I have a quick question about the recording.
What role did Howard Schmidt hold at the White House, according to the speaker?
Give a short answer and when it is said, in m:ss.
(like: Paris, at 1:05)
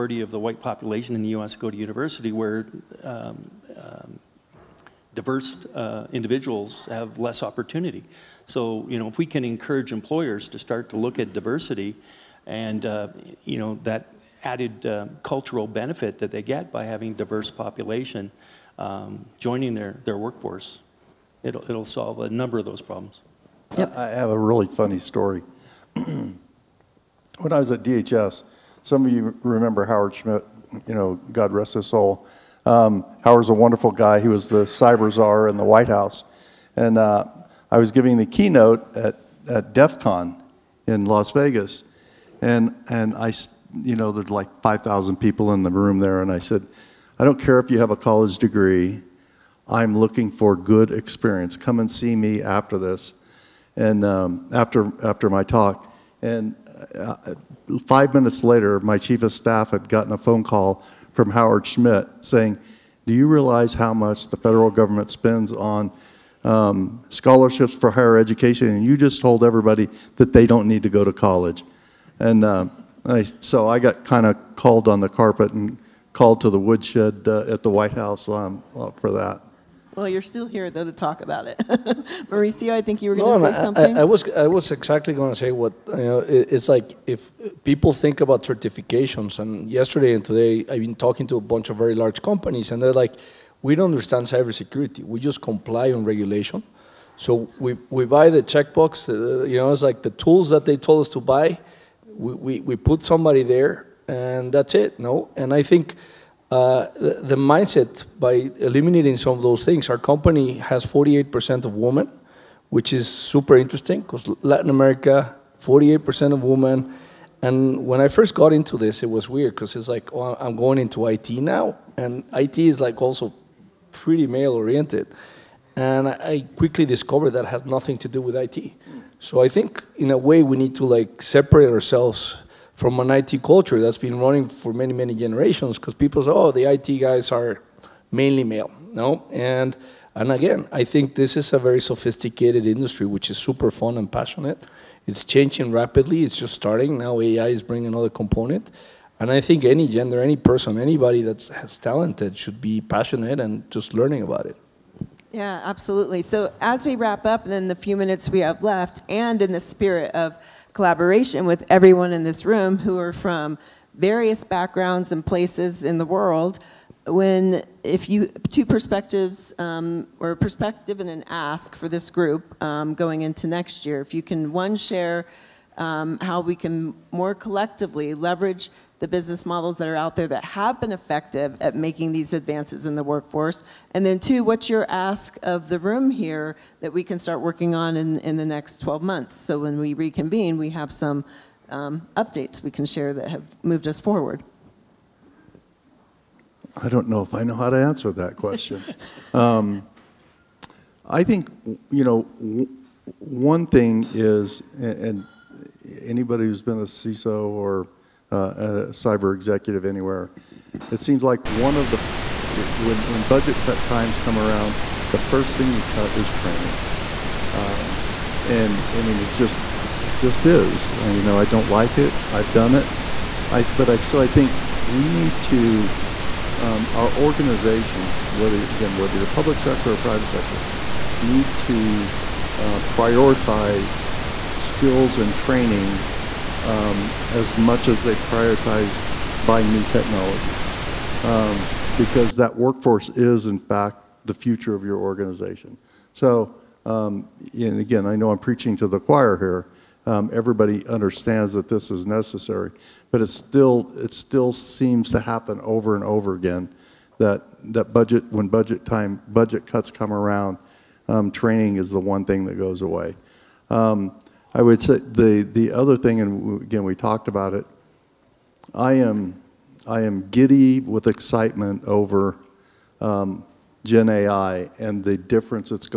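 Cyber czar, at 0:34.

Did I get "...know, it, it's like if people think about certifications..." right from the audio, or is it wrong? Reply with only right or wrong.
right.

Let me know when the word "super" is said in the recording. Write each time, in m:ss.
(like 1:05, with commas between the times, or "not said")
1:53, 2:23.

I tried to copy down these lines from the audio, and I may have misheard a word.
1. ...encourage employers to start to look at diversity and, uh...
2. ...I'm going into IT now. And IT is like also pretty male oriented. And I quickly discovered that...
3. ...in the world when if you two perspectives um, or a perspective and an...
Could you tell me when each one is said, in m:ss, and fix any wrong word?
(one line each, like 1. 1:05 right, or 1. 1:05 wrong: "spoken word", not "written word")
1. 0:09 right
2. 2:00 right
3. 2:45 right.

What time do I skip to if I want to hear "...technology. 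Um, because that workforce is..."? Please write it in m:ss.
3:59.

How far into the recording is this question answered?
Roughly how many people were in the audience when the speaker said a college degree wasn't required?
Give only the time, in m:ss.
0:44.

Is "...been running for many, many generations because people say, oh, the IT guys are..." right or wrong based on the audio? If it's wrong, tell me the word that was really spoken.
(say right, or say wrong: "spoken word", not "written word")
right.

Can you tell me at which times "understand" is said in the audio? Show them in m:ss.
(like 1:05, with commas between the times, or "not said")
1:33, 4:10.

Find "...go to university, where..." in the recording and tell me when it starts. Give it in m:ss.
0:01.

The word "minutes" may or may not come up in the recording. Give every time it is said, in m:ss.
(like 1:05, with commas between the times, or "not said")
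0:58, 2:37.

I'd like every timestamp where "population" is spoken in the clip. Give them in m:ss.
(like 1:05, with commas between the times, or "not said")
0:00, 0:17.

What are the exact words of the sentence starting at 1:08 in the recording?
And you just told everybody that they don't need to go to college.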